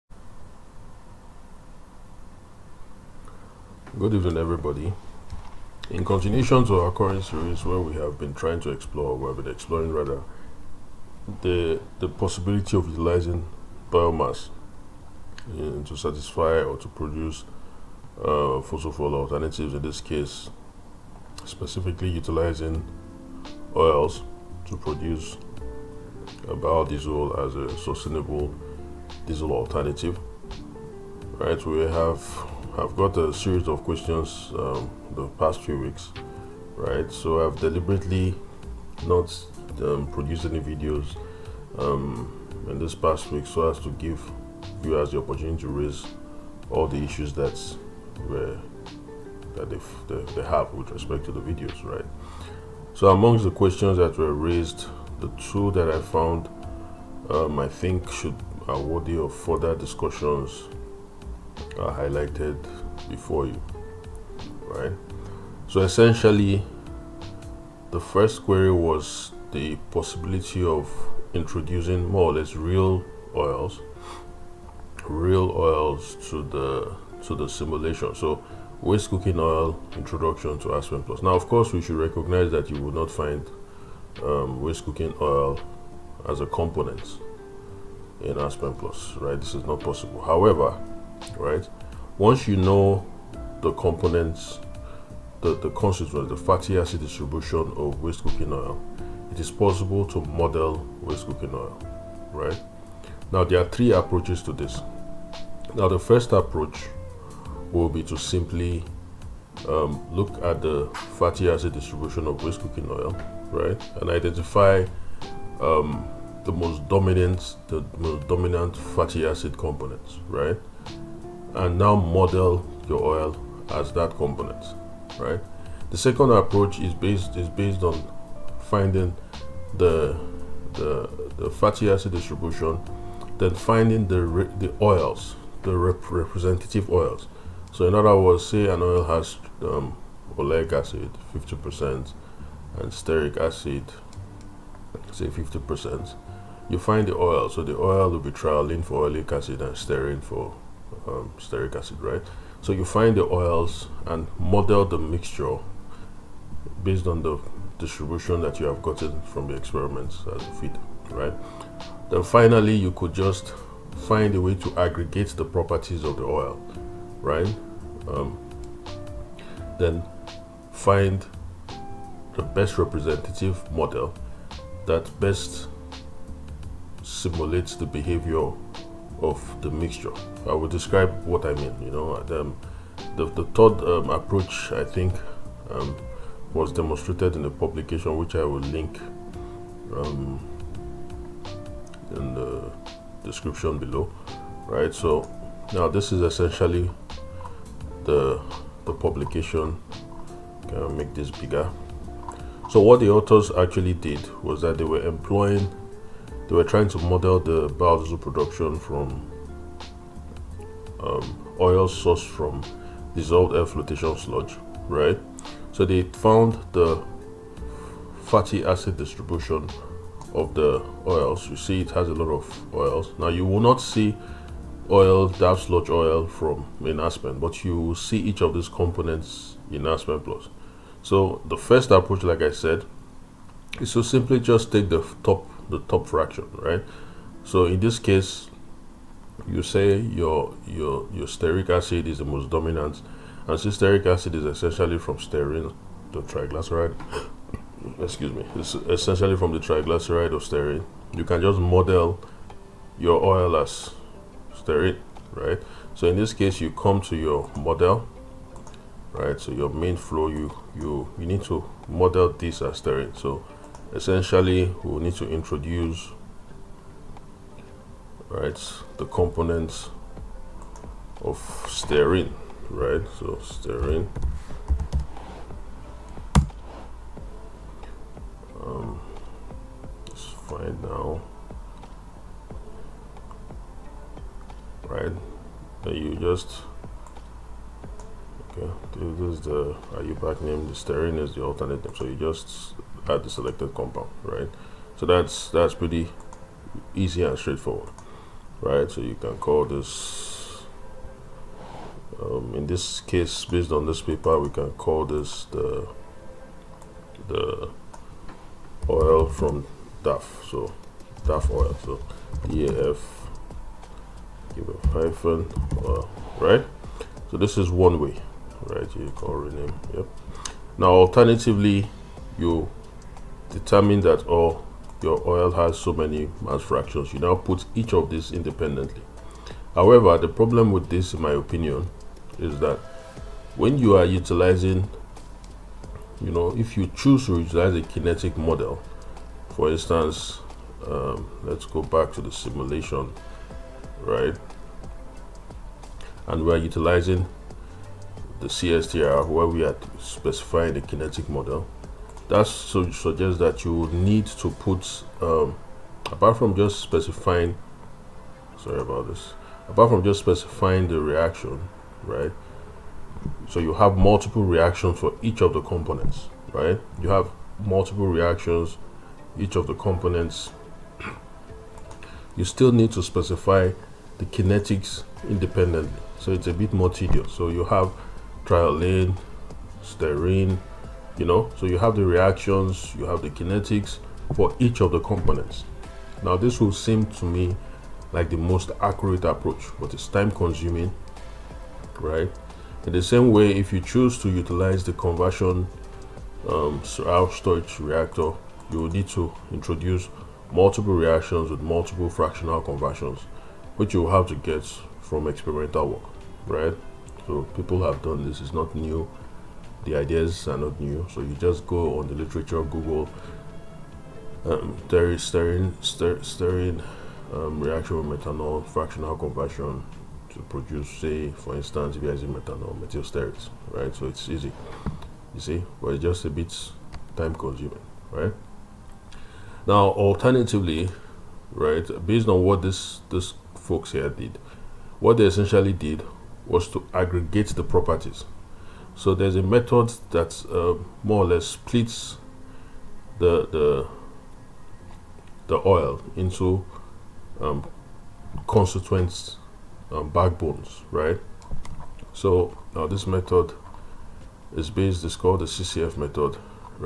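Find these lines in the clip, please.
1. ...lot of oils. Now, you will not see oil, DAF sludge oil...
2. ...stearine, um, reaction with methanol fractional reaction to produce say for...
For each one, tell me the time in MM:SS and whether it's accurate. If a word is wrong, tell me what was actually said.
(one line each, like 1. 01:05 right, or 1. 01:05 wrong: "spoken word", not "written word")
1. 03:42 right
2. 06:56 wrong: "conversion", not "reaction".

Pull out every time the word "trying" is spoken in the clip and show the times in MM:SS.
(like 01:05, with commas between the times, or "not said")
00:08, 03:26.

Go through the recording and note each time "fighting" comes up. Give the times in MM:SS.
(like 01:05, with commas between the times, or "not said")
not said.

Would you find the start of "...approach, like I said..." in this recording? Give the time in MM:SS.
03:51.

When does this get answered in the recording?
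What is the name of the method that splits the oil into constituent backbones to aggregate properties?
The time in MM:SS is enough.
07:35.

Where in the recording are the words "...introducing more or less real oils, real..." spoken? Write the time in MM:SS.
01:11.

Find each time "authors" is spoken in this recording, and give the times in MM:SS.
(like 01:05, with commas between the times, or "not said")
03:23.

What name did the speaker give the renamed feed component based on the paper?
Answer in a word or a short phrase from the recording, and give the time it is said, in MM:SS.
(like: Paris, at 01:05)
DAF oil, at 05:11.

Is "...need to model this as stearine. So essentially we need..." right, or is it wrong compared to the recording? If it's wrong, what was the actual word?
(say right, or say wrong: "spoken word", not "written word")
right.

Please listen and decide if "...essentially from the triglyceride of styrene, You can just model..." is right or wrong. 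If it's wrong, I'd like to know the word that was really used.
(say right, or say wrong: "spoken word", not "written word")
wrong: "stearine", not "styrene".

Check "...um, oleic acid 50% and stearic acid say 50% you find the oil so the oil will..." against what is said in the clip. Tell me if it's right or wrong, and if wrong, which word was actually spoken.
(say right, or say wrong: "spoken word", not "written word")
right.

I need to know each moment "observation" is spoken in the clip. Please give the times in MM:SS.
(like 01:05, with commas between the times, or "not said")
not said.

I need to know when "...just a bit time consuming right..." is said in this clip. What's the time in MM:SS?
07:06.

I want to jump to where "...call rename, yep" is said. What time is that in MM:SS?
05:19.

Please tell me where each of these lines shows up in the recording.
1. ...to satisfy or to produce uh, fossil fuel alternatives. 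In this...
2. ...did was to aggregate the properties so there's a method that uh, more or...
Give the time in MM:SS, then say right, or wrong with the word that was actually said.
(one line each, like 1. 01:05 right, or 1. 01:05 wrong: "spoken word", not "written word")
1. 00:15 right
2. 07:15 right.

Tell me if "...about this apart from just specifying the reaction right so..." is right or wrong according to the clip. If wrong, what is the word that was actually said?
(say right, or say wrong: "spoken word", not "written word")
right.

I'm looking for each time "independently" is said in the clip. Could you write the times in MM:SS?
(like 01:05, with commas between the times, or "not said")
05:28, 06:15.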